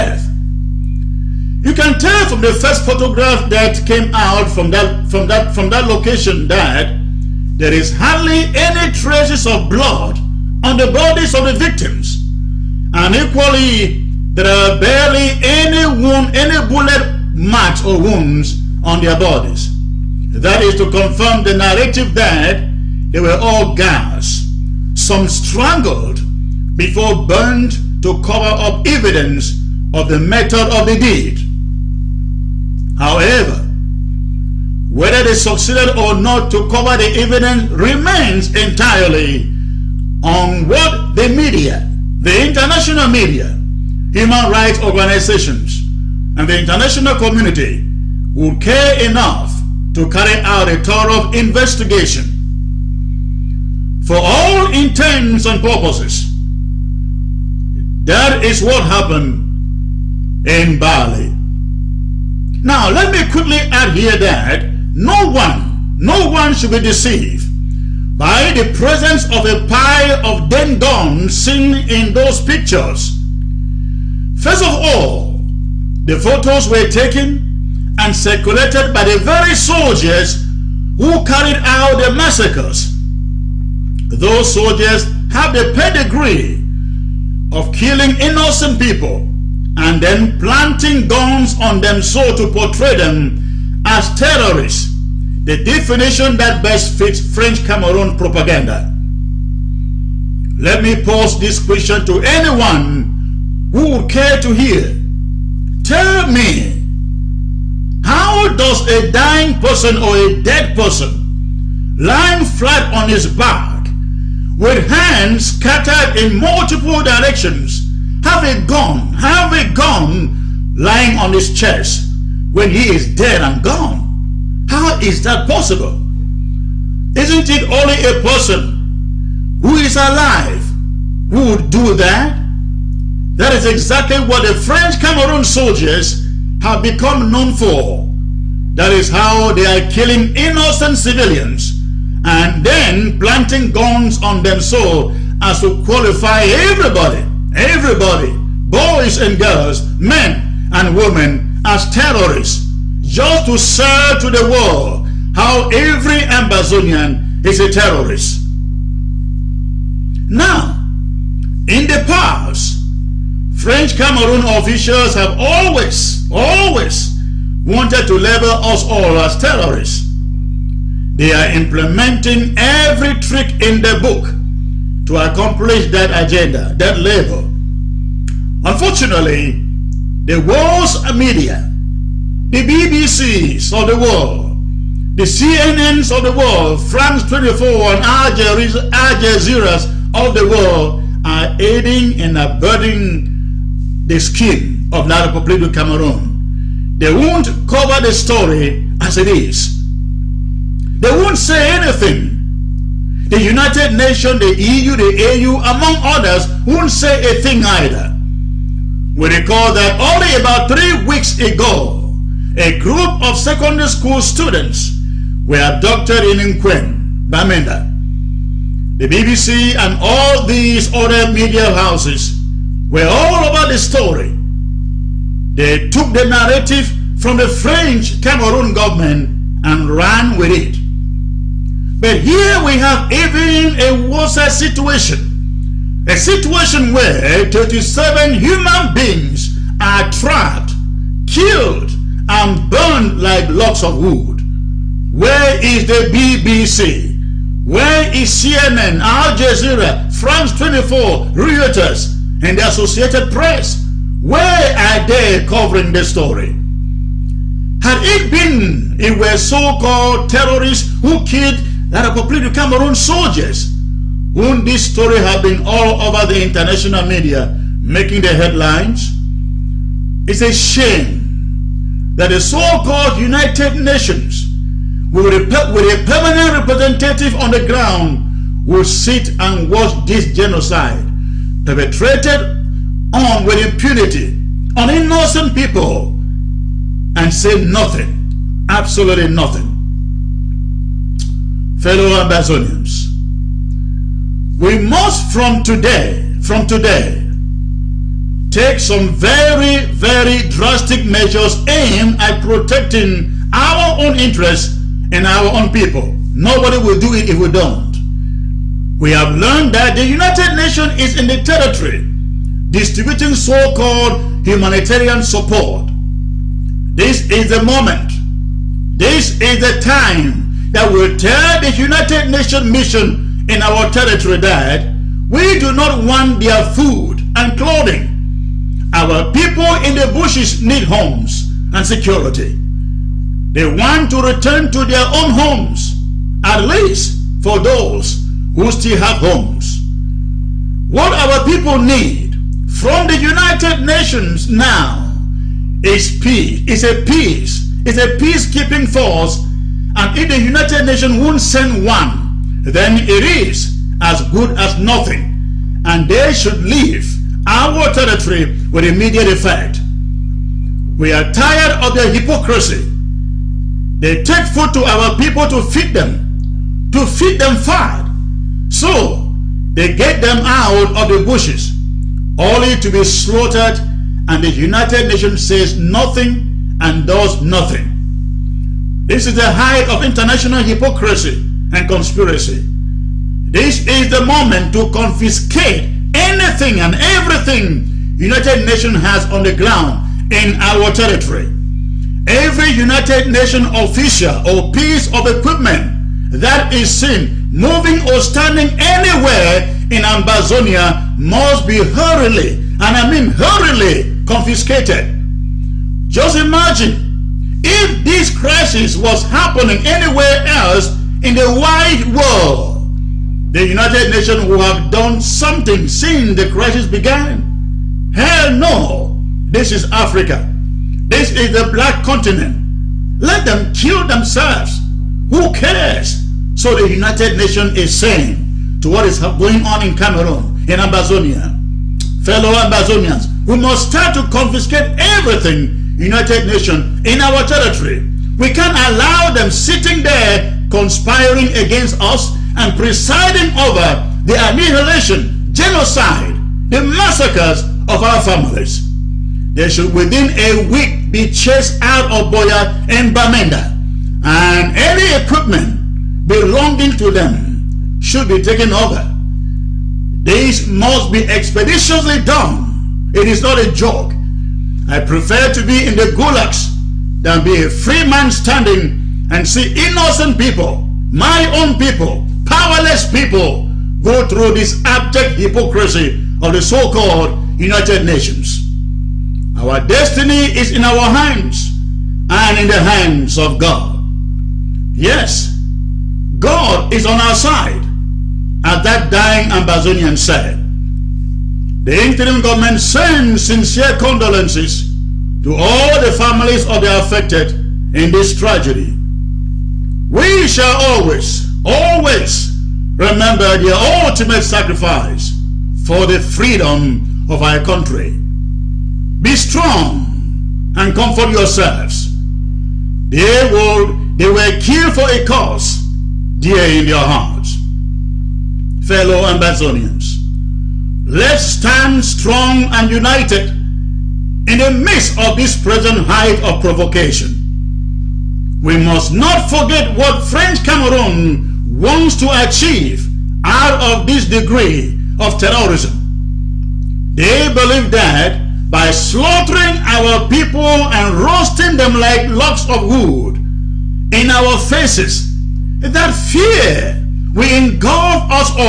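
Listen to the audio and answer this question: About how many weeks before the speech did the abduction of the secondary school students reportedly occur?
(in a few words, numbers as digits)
3.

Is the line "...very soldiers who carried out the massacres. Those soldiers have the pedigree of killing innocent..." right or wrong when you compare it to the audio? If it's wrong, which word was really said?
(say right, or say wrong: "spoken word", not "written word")
right.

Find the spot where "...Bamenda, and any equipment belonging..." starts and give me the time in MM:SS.
07:33.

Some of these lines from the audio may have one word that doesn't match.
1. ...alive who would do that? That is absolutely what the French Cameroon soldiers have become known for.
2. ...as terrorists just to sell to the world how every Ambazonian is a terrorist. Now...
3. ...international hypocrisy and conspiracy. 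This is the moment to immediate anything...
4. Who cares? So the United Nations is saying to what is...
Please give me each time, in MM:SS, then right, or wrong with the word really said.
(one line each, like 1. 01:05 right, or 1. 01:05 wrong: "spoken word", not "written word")
1. 02:09 wrong: "exactly", not "absolutely"
2. 02:31 right
3. 06:20 wrong: "confiscate", not "immediate"
4. 07:05 right.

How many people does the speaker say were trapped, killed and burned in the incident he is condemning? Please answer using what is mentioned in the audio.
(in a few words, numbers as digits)
37.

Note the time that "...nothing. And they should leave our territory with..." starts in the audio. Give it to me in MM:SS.
05:54.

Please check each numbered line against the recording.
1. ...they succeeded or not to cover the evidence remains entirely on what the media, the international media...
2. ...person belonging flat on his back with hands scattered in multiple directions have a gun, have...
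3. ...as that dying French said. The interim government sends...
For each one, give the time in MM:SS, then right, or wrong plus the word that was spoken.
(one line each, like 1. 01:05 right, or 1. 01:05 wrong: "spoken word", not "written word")
1. 00:35 right
2. 01:50 wrong: "lying", not "belonging"
3. 08:08 wrong: "Ambazonian", not "French".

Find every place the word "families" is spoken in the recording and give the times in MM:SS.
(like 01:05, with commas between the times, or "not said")
07:28, 08:16.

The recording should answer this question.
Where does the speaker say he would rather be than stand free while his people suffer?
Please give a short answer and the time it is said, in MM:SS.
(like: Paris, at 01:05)
the gulags, at 07:45.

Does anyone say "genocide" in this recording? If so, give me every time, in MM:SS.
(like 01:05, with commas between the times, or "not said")
04:40, 07:25.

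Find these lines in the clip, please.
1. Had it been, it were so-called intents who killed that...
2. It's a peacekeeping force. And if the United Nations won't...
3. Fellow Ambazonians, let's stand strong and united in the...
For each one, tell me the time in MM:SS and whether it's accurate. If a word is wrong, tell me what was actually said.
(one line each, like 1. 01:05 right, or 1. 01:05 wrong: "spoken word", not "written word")
1. 04:17 wrong: "terrorists", not "intents"
2. 05:47 right
3. 08:38 right.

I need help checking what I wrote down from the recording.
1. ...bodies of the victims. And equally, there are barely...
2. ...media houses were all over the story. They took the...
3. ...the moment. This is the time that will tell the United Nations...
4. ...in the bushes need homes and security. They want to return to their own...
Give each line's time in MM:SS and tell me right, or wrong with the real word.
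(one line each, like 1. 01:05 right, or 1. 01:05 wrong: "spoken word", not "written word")
1. 00:10 right
2. 03:41 right
3. 05:17 right
4. 05:29 right.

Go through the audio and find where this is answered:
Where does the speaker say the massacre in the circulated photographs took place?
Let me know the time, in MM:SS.
01:00.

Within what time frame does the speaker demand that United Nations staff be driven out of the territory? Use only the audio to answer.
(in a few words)
within a week.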